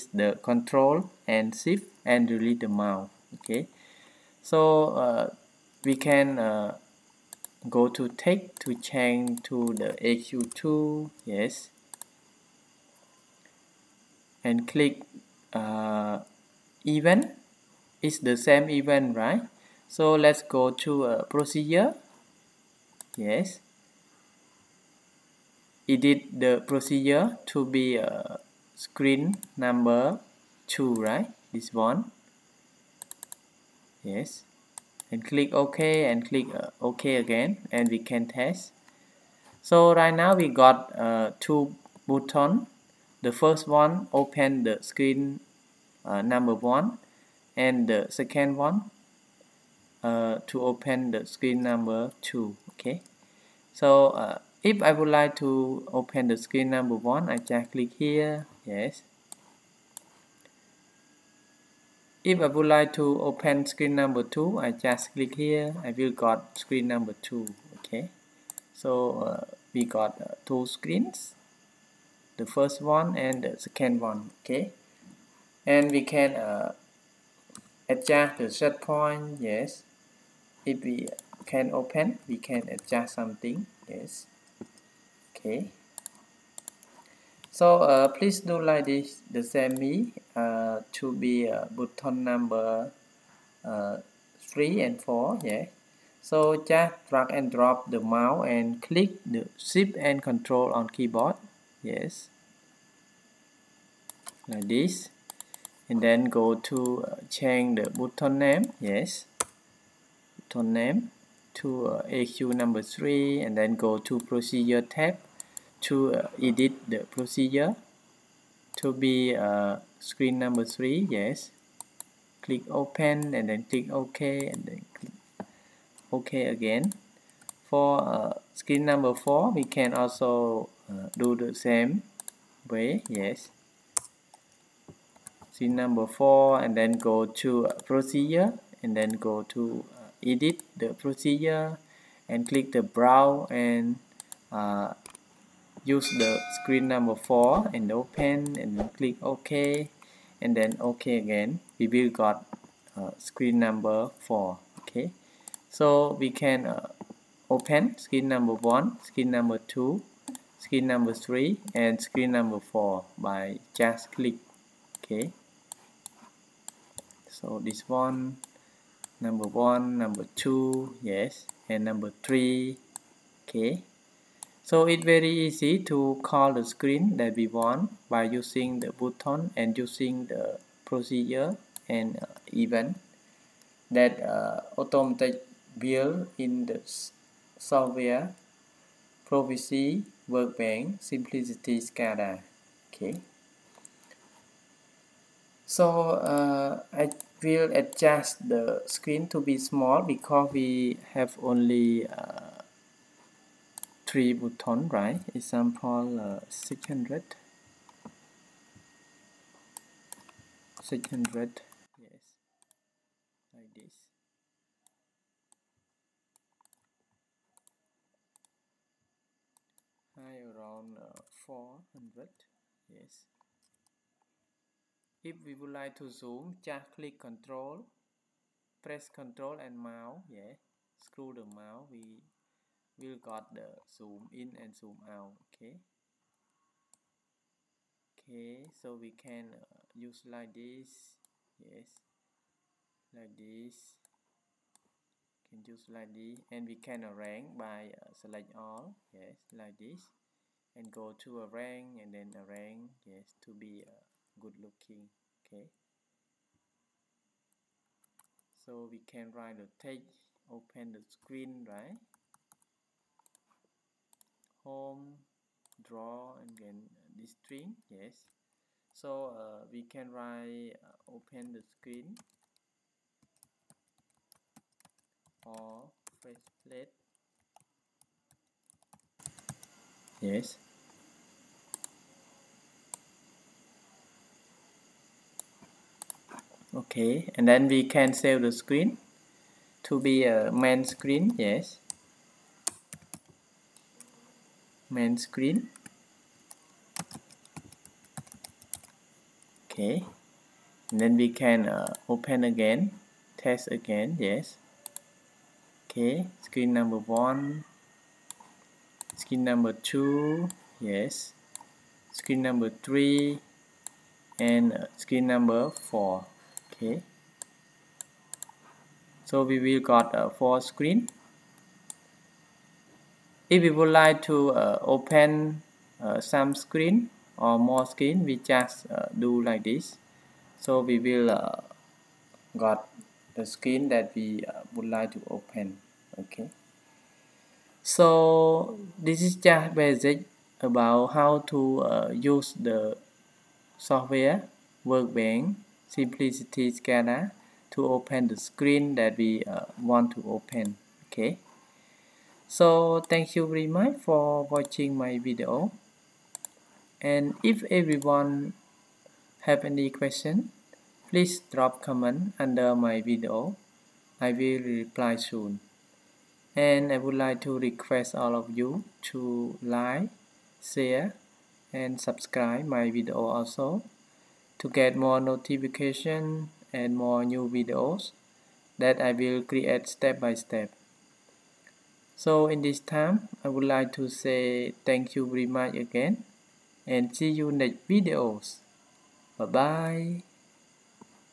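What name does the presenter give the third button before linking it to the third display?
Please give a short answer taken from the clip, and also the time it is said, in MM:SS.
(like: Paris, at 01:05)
AQ3, at 01:52.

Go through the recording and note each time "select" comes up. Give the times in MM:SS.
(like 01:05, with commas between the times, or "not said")
04:08.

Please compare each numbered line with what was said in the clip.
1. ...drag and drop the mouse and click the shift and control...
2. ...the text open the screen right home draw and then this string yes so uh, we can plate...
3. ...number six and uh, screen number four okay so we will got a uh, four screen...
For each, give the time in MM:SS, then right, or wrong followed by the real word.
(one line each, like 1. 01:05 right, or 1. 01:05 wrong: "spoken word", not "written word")
1. 01:37 right
2. 04:19 wrong: "write", not "plate"
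3. 05:12 wrong: "three", not "six".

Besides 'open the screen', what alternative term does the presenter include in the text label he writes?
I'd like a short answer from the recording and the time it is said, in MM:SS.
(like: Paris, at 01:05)
face plate, at 04:36.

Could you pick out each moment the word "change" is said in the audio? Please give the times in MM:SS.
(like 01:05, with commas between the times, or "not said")
00:08, 01:47.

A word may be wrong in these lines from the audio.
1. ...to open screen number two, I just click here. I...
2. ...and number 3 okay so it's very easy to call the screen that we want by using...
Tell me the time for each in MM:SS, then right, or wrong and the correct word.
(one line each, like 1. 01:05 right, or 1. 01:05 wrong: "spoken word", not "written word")
1. 01:02 right
2. 02:51 right.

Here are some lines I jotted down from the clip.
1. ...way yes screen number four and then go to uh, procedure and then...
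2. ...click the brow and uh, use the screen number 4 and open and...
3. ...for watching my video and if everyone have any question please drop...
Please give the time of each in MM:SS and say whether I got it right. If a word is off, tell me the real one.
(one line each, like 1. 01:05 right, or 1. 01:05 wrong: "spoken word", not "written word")
1. 02:12 right
2. 02:22 right
3. 05:53 right.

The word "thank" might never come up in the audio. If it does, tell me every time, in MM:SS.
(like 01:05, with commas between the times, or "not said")
05:53, 06:24.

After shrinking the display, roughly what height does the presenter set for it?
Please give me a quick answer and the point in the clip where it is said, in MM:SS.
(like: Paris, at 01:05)
400, at 03:40.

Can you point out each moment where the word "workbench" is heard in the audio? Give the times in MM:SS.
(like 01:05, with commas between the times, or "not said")
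03:10, 05:44.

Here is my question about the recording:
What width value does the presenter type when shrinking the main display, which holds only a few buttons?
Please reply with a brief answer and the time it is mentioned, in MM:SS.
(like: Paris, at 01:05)
600, at 03:26.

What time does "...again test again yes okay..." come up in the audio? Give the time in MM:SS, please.
05:02.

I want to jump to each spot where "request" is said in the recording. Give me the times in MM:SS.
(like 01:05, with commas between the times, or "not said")
06:07.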